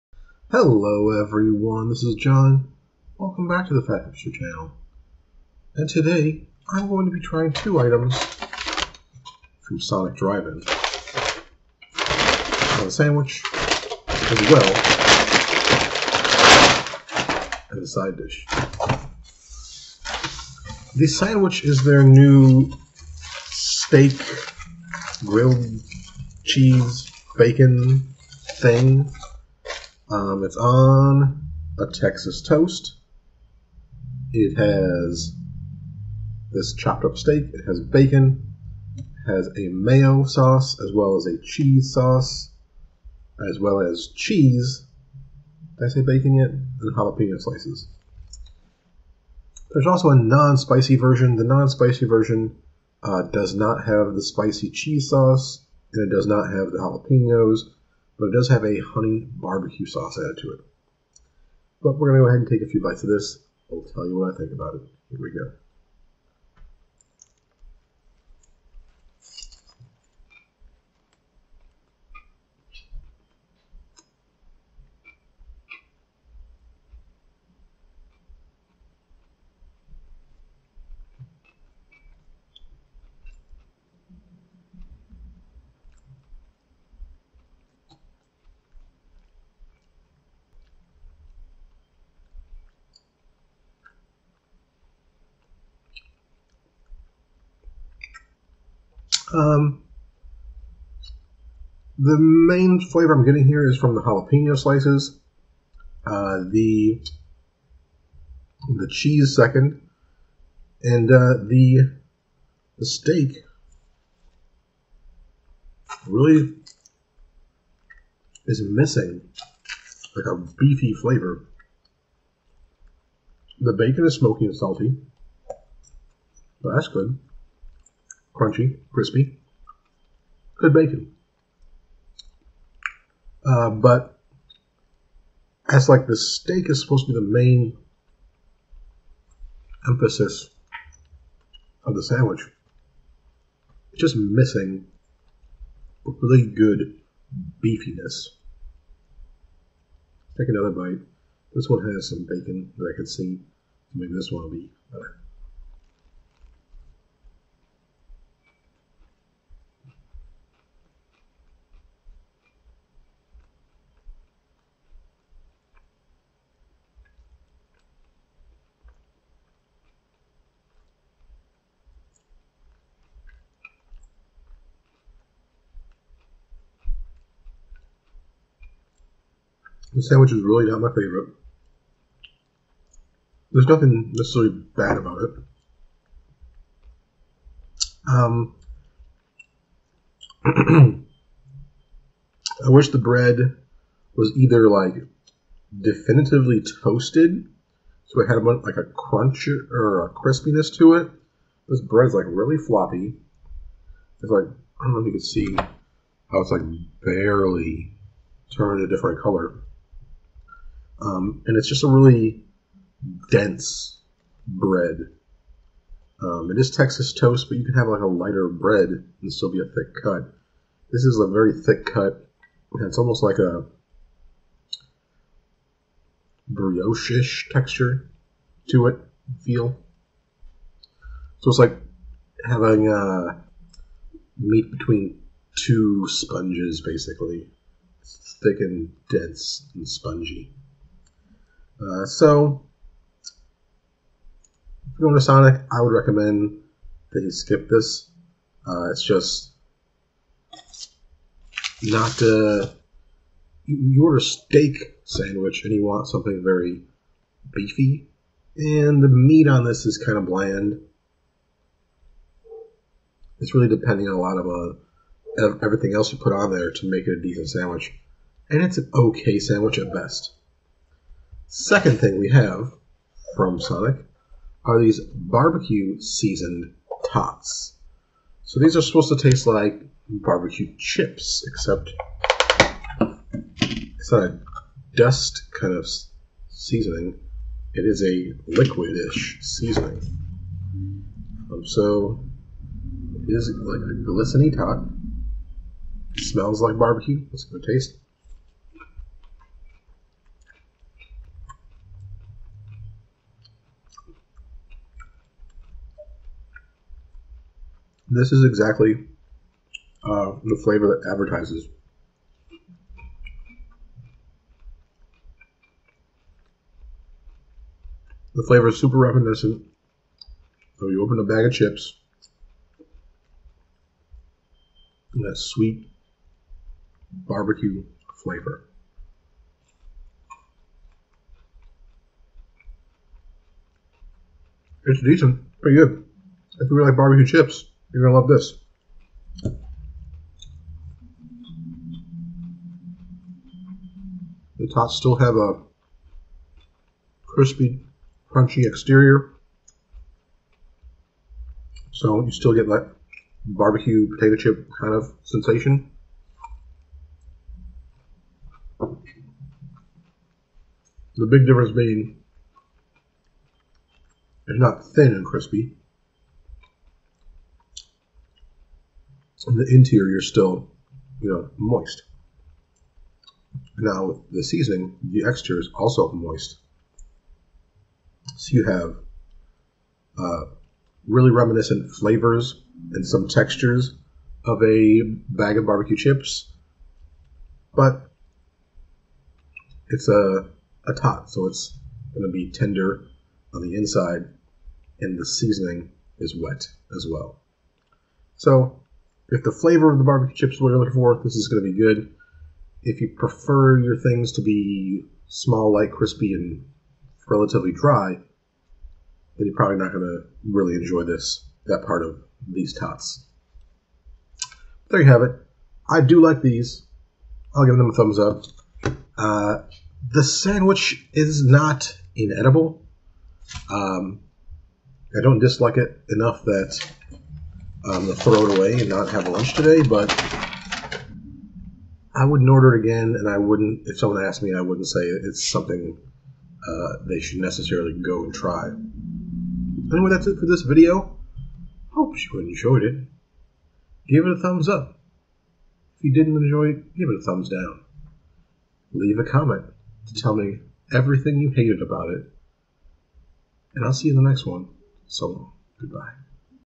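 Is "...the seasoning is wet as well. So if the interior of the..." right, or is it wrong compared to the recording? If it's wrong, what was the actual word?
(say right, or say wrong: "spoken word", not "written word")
wrong: "flavor", not "interior".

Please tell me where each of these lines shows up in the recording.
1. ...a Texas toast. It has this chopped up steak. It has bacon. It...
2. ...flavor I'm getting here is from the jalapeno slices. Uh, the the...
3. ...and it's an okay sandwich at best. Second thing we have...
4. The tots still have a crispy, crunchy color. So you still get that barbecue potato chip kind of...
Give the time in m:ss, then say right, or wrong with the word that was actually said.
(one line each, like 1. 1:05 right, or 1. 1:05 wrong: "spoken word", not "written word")
1. 0:31 right
2. 1:42 right
3. 4:28 right
4. 5:44 wrong: "exterior", not "color".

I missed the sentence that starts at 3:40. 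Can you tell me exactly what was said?
This is a very thick cut, and it's almost like a brioche-ish texture to it, feel.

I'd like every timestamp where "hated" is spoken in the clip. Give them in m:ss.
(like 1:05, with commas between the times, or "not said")
7:31.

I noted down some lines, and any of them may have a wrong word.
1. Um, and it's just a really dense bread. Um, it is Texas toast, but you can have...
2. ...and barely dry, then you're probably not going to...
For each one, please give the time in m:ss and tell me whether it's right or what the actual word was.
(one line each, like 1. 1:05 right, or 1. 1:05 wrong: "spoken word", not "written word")
1. 3:31 right
2. 6:46 wrong: "relatively", not "barely".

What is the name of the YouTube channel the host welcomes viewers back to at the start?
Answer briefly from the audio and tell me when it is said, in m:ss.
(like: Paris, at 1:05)
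Fat Hipster, at 0:03.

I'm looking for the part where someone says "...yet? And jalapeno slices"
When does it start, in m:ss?
0:46.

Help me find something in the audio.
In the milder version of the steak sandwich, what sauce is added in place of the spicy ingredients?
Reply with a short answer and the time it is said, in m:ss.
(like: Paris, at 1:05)
honey barbecue sauce, at 0:58.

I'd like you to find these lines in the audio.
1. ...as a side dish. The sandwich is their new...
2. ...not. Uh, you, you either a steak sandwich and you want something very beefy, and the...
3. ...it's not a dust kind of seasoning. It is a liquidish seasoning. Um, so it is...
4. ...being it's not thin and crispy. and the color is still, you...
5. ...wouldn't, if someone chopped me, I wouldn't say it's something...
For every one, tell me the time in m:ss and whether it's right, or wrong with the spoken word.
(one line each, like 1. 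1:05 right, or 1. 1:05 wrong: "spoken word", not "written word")
1. 0:17 right
2. 4:11 wrong: "order", not "either"
3. 4:43 right
4. 6:01 wrong: "interior", not "color"
5. 7:13 wrong: "asked", not "chopped".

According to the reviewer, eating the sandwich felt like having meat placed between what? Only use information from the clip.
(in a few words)
two sponges.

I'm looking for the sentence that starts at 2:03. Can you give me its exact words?
The bacon is smoky and salty.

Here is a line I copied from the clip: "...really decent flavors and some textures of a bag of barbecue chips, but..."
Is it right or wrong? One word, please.
wrong.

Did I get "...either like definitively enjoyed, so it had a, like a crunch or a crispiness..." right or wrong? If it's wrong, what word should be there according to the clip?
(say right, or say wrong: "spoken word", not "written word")
wrong: "toasted", not "enjoyed".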